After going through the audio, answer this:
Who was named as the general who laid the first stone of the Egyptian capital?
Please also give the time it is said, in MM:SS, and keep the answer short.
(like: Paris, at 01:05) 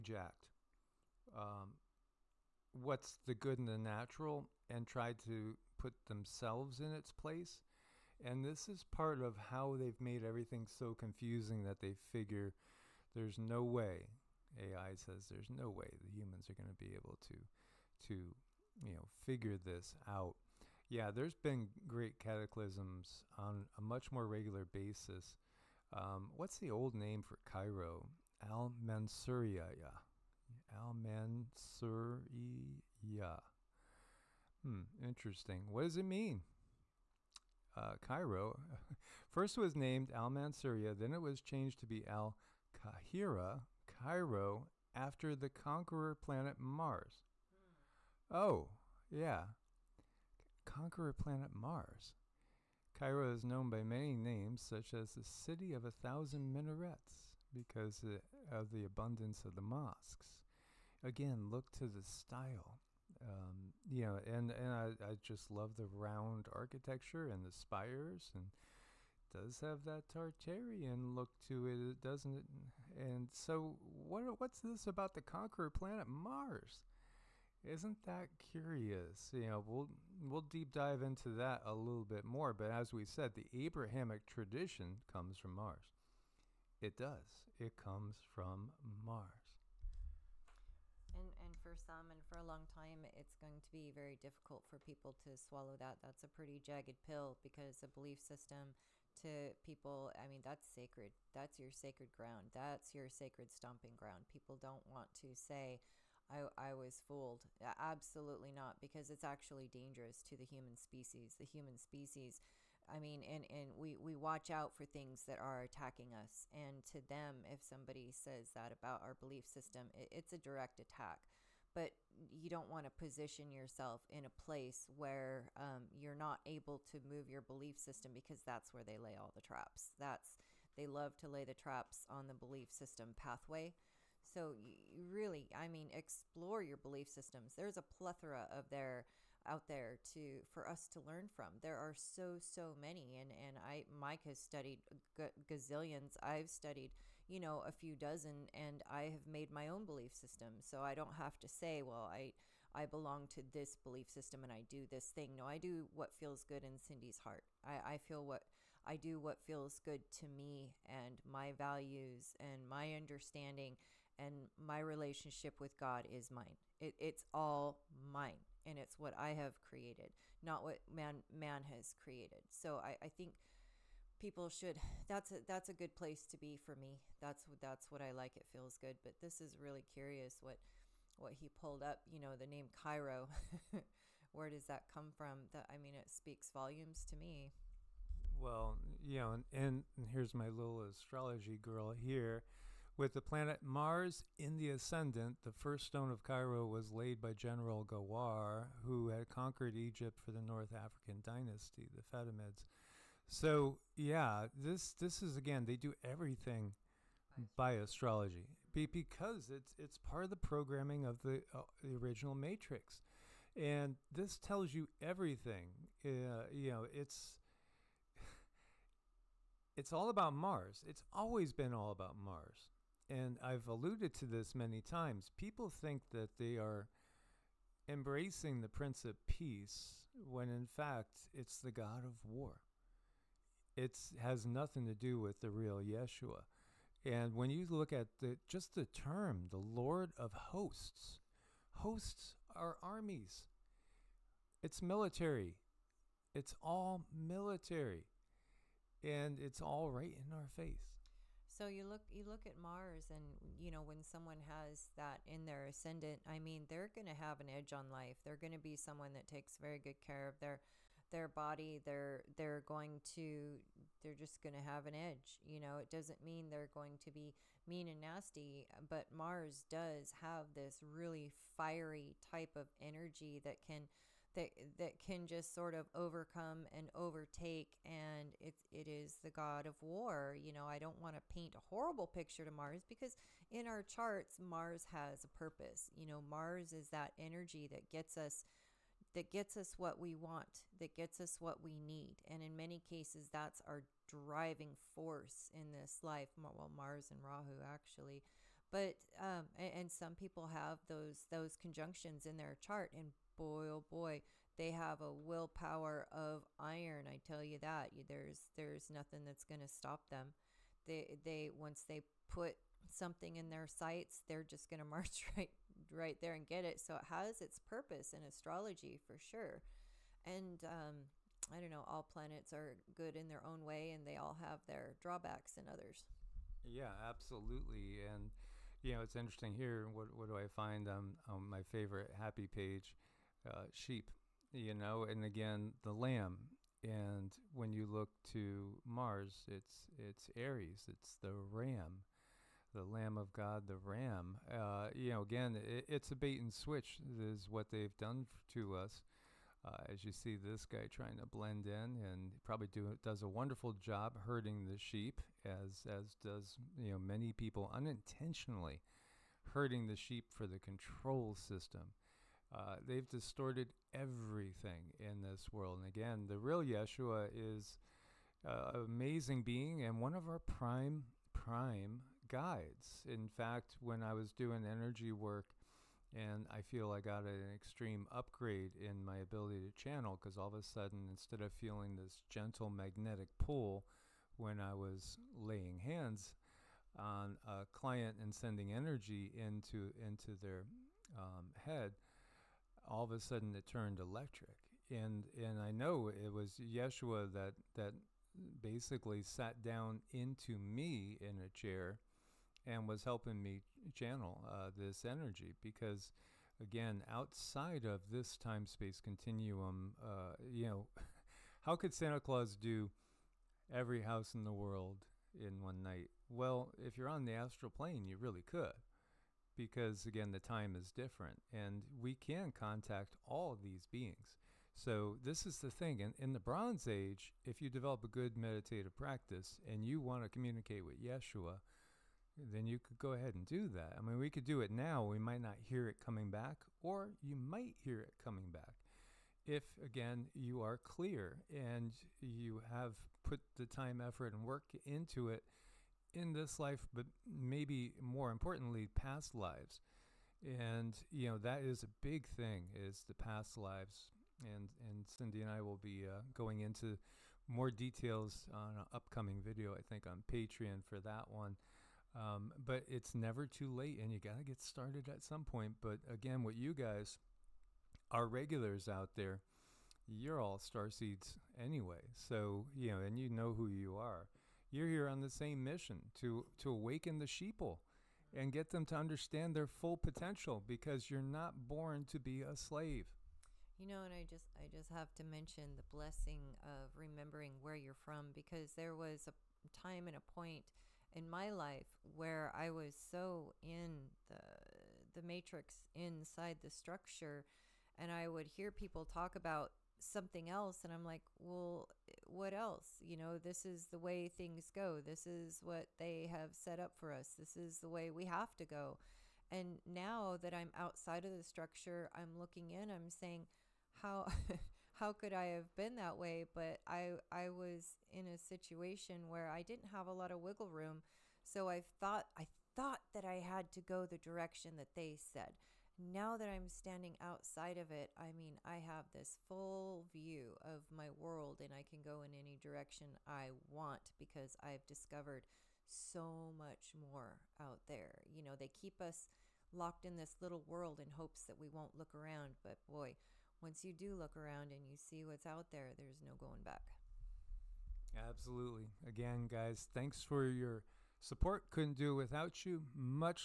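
Gawar, at 03:17.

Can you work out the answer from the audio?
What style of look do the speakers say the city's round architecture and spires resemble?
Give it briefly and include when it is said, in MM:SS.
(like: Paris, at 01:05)
Tartarian, at 01:10.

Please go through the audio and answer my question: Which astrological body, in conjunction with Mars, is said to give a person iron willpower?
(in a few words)
Rahu.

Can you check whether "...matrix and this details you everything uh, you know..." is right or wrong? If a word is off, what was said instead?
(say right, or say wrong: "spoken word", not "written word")
wrong: "tells", not "details".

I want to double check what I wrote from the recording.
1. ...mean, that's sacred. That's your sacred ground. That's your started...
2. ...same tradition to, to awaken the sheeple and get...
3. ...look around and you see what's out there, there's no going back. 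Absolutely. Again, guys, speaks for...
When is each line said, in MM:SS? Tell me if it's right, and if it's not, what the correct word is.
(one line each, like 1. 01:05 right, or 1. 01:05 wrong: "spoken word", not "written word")
1. 01:40 wrong: "sacred", not "started"
2. 07:55 wrong: "mission", not "tradition"
3. 09:04 wrong: "thanks", not "speaks".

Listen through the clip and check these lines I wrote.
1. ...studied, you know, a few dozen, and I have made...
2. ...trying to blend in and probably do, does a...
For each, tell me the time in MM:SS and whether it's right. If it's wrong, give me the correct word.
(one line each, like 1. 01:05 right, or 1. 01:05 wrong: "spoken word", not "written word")
1. 02:26 right
2. 05:50 right.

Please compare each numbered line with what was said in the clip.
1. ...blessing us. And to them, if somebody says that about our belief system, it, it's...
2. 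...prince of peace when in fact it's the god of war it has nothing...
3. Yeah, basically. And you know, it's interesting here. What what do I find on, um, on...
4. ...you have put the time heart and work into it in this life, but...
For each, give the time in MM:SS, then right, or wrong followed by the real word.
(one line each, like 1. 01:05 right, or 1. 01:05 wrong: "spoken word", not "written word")
1. 01:55 wrong: "attacking", not "blessing"
2. 03:48 right
3. 05:26 wrong: "absolutely", not "basically"
4. 07:22 wrong: "effort", not "heart".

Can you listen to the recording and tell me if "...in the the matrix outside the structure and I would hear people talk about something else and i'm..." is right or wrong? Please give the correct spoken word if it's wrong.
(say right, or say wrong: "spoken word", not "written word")
wrong: "inside", not "outside".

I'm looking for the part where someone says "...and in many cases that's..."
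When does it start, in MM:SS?
04:52.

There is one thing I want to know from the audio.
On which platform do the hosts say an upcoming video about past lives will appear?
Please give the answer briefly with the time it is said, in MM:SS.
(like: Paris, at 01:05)
Patreon, at 07:40.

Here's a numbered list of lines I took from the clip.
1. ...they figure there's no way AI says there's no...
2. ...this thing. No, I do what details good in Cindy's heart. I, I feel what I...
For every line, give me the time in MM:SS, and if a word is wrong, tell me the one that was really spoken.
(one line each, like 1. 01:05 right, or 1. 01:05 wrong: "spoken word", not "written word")
1. 00:11 right
2. 02:34 wrong: "feels", not "details".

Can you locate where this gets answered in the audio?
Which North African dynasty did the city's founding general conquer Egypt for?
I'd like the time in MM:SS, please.
03:21.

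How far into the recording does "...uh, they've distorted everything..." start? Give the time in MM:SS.
06:02.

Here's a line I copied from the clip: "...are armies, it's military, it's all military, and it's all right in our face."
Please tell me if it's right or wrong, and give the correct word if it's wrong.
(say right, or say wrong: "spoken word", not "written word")
right.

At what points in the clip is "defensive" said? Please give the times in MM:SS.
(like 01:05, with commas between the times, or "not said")
not said.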